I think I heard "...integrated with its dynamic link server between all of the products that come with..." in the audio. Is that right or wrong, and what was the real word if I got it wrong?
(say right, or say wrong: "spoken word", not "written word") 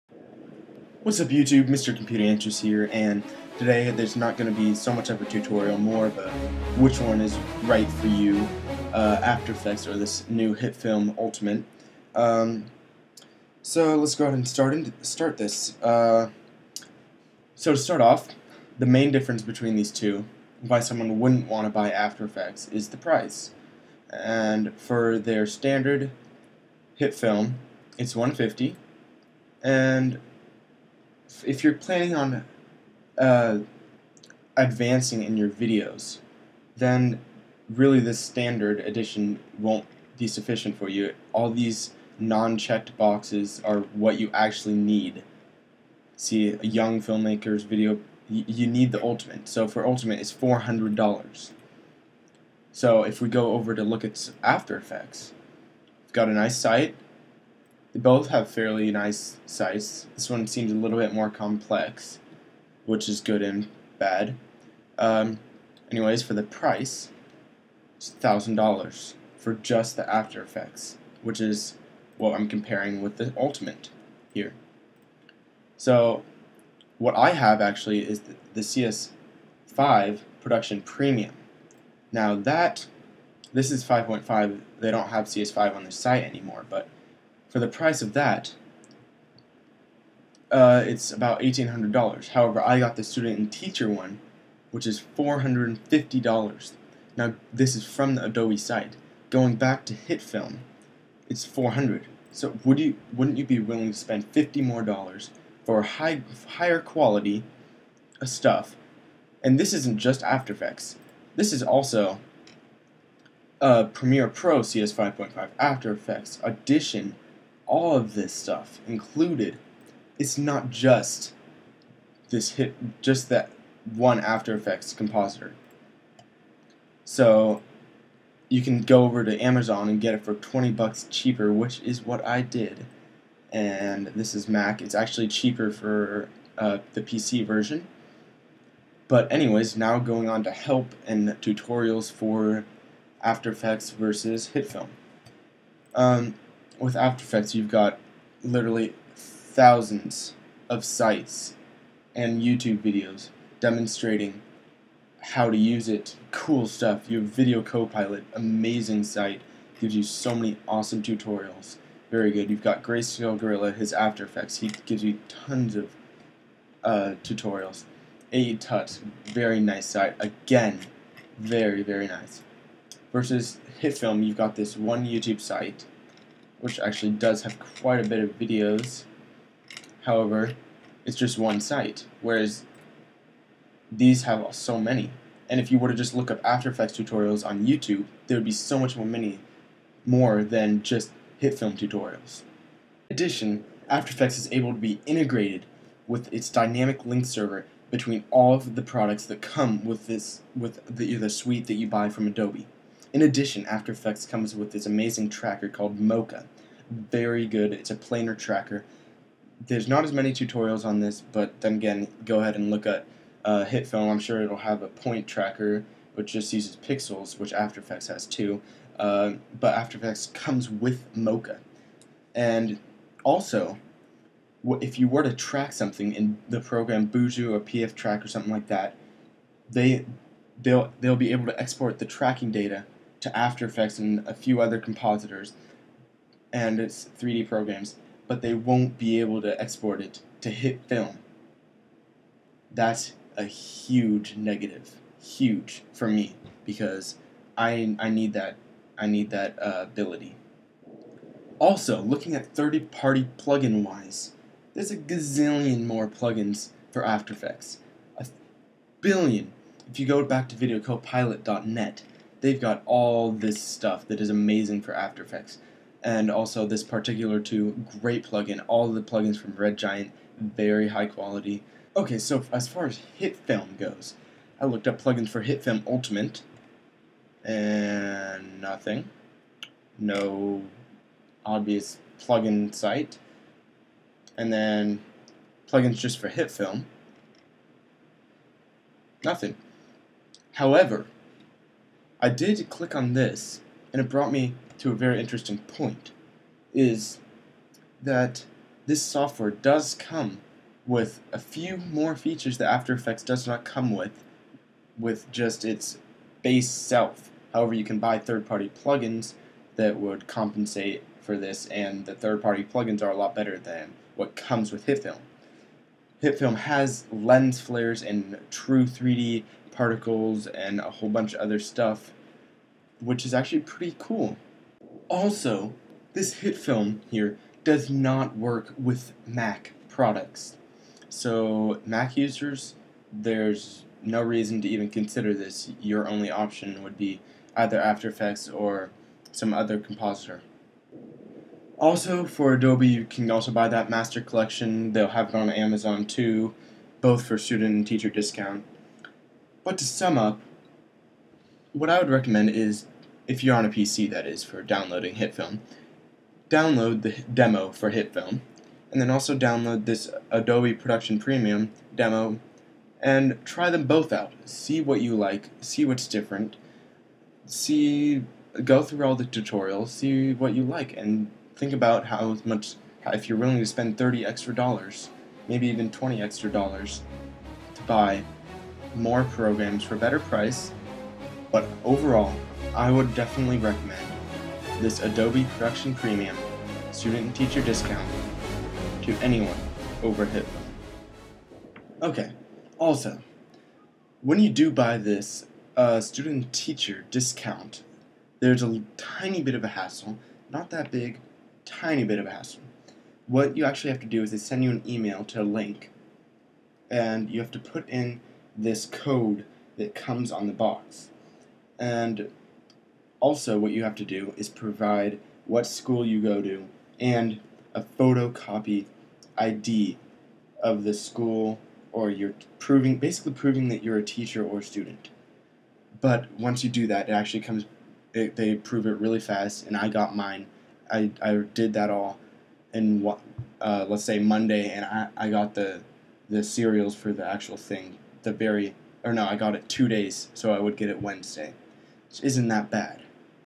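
right.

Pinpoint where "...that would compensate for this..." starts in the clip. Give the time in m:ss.
5:09.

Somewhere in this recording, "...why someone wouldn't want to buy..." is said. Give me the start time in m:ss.
0:20.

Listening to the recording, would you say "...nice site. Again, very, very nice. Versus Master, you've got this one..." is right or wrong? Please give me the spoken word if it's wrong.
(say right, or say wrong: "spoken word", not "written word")
wrong: "HitFilm", not "Master".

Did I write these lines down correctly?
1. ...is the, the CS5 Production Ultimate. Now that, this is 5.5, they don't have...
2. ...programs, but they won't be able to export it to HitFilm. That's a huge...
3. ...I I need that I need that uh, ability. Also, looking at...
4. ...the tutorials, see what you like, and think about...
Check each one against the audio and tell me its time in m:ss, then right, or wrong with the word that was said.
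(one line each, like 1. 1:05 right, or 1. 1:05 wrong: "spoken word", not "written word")
1. 1:18 wrong: "Premium", not "Ultimate"
2. 3:57 right
3. 4:07 right
4. 6:09 right.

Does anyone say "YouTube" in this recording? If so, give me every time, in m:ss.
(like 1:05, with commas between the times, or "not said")
0:01, 2:32, 2:55, 3:07.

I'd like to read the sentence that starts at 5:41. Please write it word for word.
Also, for Adobe, you can also buy that Master Collection.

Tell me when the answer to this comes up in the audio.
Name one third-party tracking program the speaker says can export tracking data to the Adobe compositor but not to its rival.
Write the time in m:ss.
3:47.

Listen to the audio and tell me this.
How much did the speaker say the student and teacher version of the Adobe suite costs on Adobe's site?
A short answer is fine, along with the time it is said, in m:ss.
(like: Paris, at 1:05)
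$450, at 1:35.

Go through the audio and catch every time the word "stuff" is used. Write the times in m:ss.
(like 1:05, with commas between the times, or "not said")
1:48, 1:58, 2:36, 4:23, 5:21.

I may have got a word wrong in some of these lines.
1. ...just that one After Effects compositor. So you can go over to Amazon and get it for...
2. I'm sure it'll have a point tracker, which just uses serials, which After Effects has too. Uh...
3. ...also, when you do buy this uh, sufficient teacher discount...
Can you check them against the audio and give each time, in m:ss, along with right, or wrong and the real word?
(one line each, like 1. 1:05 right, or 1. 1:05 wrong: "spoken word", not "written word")
1. 2:03 right
2. 3:34 wrong: "pixels", not "serials"
3. 6:32 wrong: "student", not "sufficient".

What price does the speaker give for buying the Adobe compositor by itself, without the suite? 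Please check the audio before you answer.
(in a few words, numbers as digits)
$1,000.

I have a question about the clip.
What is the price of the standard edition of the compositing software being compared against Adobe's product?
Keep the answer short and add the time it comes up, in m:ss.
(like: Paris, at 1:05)
150, at 0:28.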